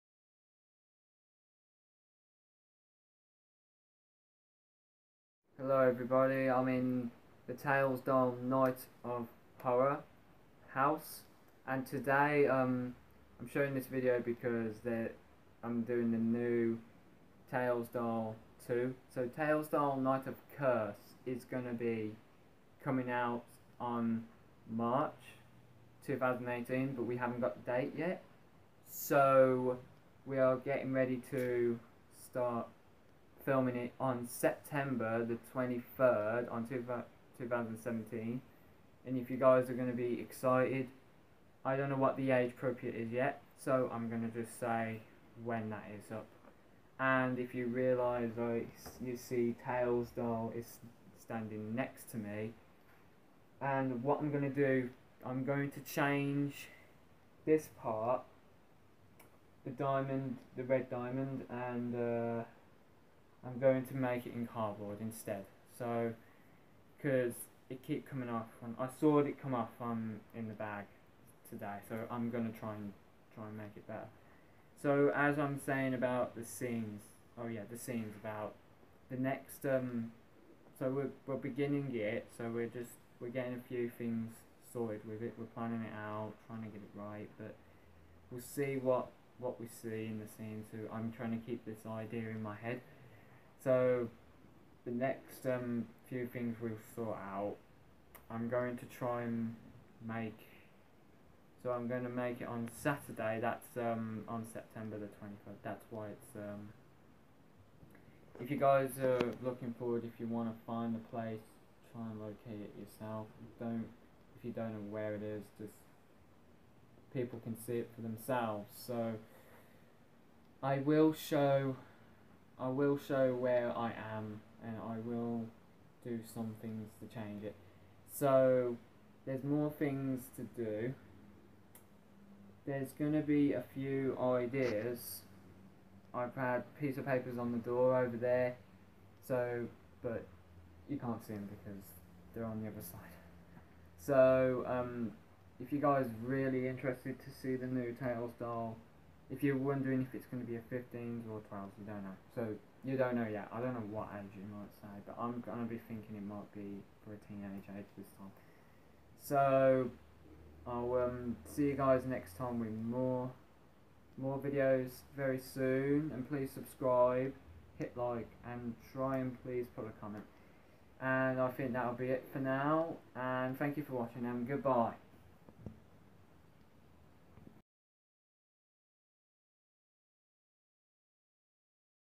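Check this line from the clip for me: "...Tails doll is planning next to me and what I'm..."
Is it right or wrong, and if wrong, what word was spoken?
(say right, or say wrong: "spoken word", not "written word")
wrong: "standing", not "planning".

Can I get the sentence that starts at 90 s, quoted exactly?
So I'm trying to keep this idea in my head.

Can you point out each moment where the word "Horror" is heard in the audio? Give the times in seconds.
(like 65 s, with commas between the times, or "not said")
9 s.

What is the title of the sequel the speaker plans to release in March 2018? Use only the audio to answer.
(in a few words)
Tails Doll Night of Curse.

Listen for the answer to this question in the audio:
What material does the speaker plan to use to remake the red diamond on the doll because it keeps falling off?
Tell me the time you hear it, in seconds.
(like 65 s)
64 s.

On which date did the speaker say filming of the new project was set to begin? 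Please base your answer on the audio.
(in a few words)
September 23.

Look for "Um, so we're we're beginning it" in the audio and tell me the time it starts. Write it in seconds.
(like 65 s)
79 s.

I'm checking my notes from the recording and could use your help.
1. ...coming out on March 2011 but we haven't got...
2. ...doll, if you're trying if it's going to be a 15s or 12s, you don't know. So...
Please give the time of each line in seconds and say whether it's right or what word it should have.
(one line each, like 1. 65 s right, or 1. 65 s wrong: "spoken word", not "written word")
1. 22 s wrong: "2018", not "2011"
2. 148 s wrong: "wondering", not "trying".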